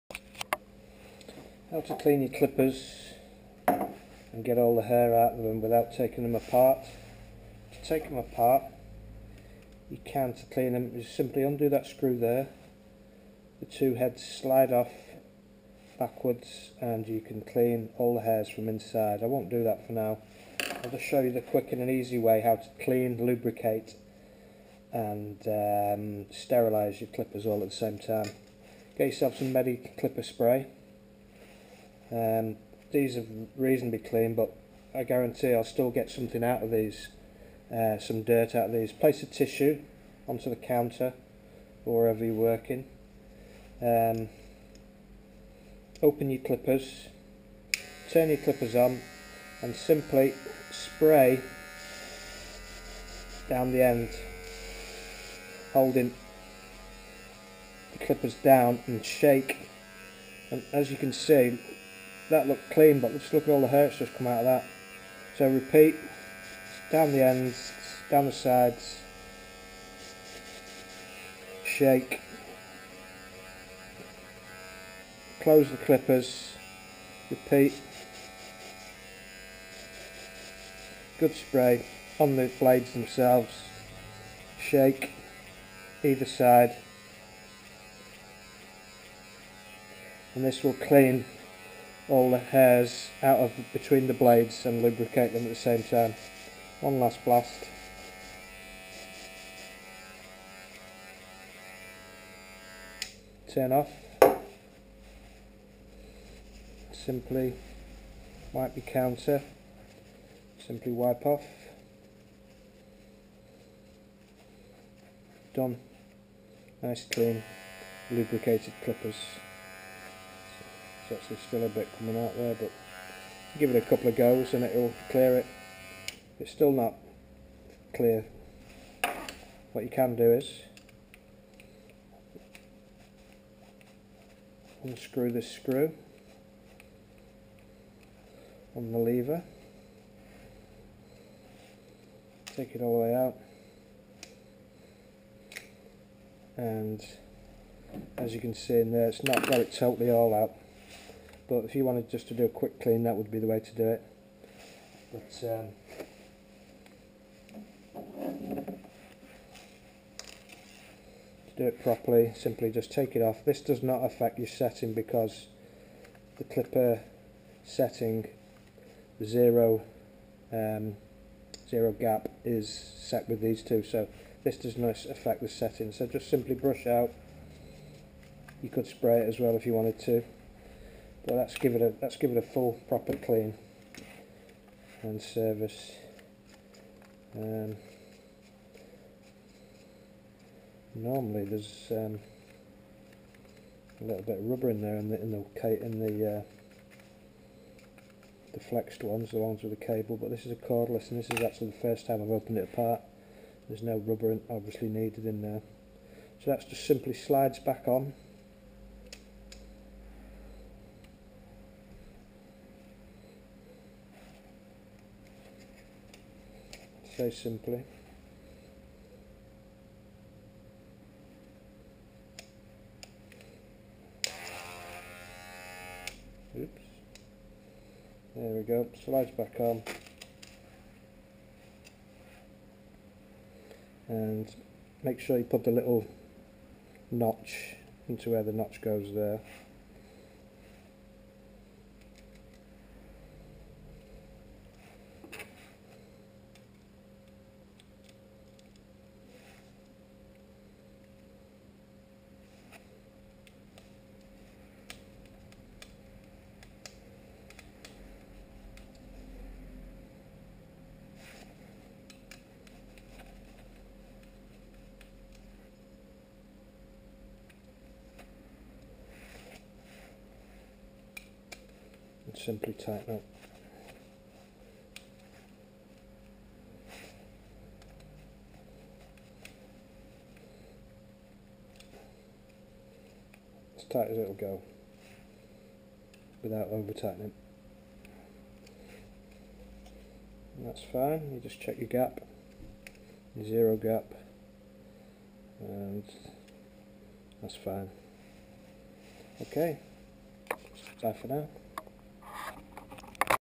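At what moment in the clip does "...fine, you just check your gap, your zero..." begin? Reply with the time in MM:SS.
04:50.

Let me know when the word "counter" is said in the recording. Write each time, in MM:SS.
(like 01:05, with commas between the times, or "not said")
00:40, 01:48.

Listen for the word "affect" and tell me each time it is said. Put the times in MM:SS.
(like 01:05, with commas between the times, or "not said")
02:43, 02:55.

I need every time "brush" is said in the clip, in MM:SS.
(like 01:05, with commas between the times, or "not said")
02:56.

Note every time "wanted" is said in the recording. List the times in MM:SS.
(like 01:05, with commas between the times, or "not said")
02:31, 02:59.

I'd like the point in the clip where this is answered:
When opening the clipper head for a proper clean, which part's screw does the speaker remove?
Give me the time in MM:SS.
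02:18.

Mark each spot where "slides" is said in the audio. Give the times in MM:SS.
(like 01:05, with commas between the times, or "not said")
00:14, 03:27, 03:49.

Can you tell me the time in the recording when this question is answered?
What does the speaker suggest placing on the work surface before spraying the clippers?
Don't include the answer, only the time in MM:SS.
00:39.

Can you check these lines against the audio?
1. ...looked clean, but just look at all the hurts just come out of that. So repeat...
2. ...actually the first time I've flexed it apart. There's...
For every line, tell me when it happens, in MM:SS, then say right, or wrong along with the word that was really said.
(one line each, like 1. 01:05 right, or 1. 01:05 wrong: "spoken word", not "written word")
1. 01:02 right
2. 03:21 wrong: "opened", not "flexed".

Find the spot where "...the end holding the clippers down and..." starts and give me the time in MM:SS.
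00:53.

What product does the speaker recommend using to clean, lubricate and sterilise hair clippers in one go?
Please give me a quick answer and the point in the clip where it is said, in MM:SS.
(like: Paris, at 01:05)
Medi Clipper Spray, at 00:29.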